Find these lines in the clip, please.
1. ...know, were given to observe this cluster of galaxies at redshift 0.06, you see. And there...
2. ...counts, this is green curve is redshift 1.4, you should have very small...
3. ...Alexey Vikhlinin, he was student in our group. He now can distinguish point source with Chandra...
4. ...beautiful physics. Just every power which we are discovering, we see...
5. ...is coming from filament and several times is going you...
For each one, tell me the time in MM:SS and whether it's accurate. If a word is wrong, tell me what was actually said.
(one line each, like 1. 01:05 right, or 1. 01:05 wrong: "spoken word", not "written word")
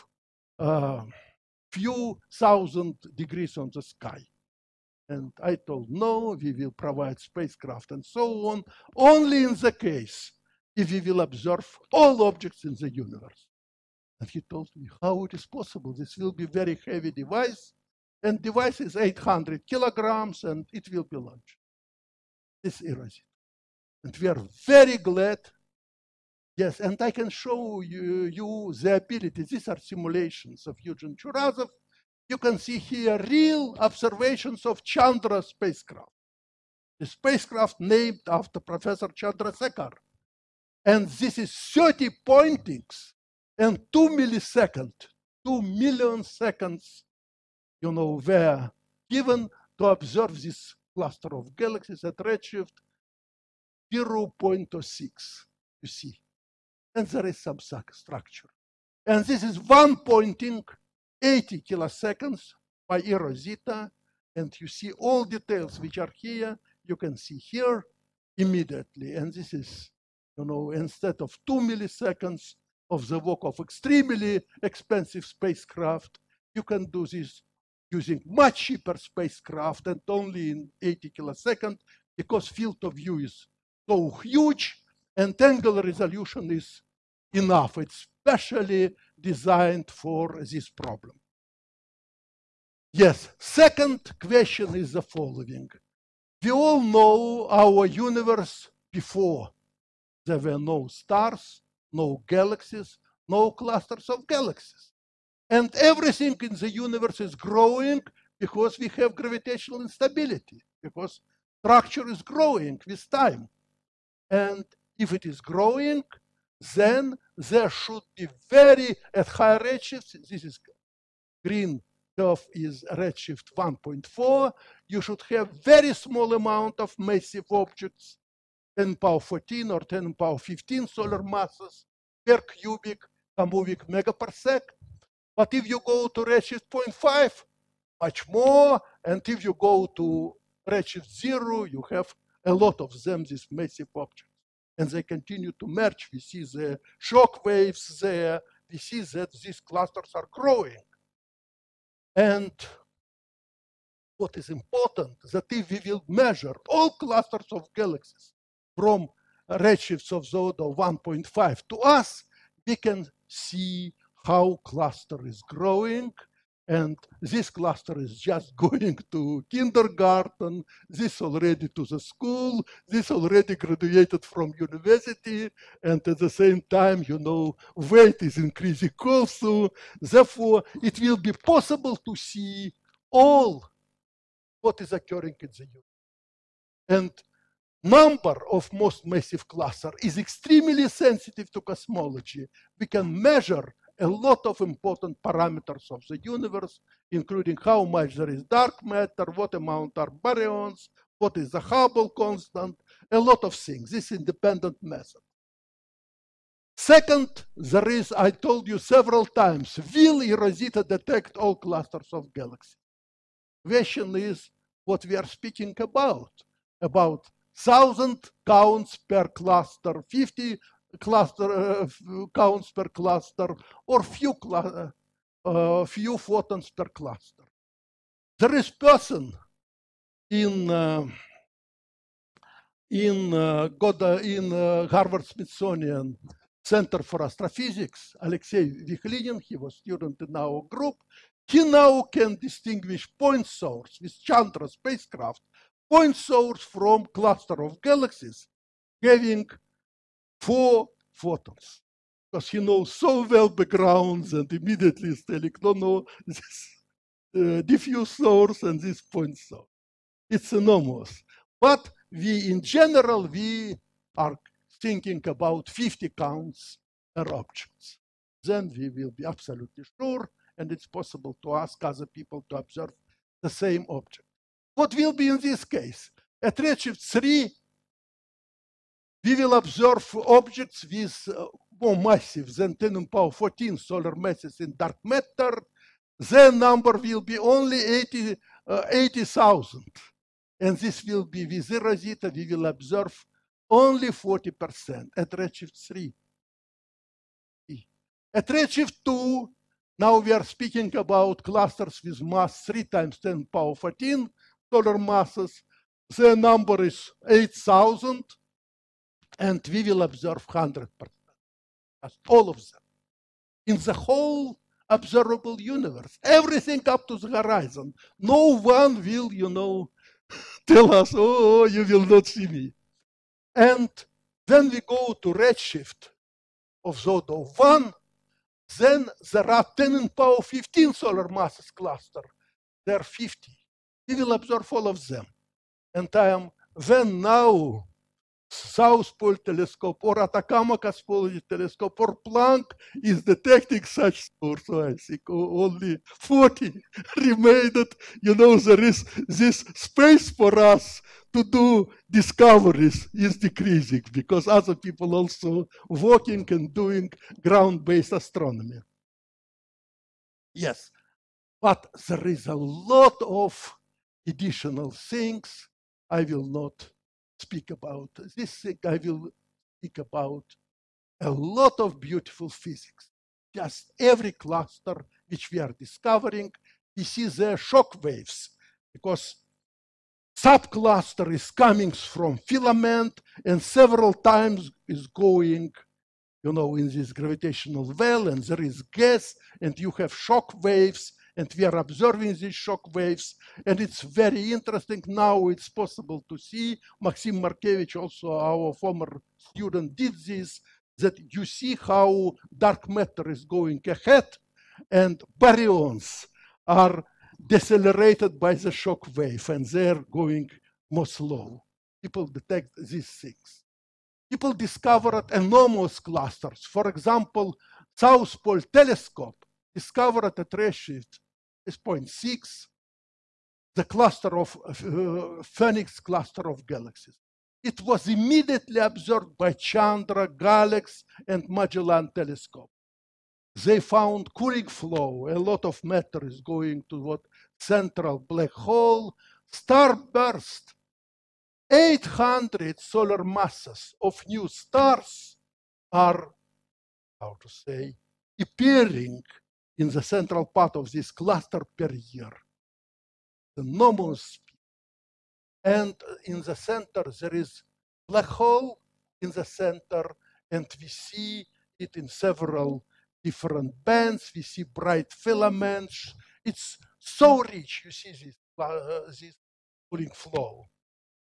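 1. 00:47 right
2. 01:59 wrong: "redshifts", not "counts"
3. 03:58 right
4. 06:11 wrong: "cluster", not "power"
5. 06:21 right.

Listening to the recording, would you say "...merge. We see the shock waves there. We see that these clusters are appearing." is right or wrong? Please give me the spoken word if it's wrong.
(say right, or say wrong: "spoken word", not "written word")
wrong: "growing", not "appearing".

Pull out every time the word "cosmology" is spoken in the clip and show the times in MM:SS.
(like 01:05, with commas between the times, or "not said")
03:11, 05:40.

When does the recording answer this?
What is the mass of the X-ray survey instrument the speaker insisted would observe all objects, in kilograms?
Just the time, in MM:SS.
00:18.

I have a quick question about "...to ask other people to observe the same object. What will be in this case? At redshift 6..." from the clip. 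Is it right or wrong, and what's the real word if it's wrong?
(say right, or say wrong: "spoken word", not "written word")
wrong: "3", not "6".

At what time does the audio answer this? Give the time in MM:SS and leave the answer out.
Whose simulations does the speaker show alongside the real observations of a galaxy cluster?
00:30.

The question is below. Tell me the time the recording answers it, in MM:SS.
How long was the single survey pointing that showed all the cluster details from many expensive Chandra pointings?
01:01.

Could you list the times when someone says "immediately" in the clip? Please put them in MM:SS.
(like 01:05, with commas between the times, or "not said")
01:08, 04:14, 07:08.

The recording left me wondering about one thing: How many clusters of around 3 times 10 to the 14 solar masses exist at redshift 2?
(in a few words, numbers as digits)
8,000.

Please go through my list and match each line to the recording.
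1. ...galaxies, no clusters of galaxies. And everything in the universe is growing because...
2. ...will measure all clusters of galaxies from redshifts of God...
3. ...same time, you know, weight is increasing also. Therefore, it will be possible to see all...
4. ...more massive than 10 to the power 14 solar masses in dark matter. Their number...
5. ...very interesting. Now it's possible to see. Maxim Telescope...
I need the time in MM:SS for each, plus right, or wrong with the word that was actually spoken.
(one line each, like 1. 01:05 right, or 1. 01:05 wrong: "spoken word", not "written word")
1. 01:42 right
2. 02:35 wrong: "Zodo", not "God"
3. 02:56 right
4. 04:41 right
5. 06:34 wrong: "Markevitch", not "Telescope".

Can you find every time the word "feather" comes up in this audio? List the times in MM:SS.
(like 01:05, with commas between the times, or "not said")
not said.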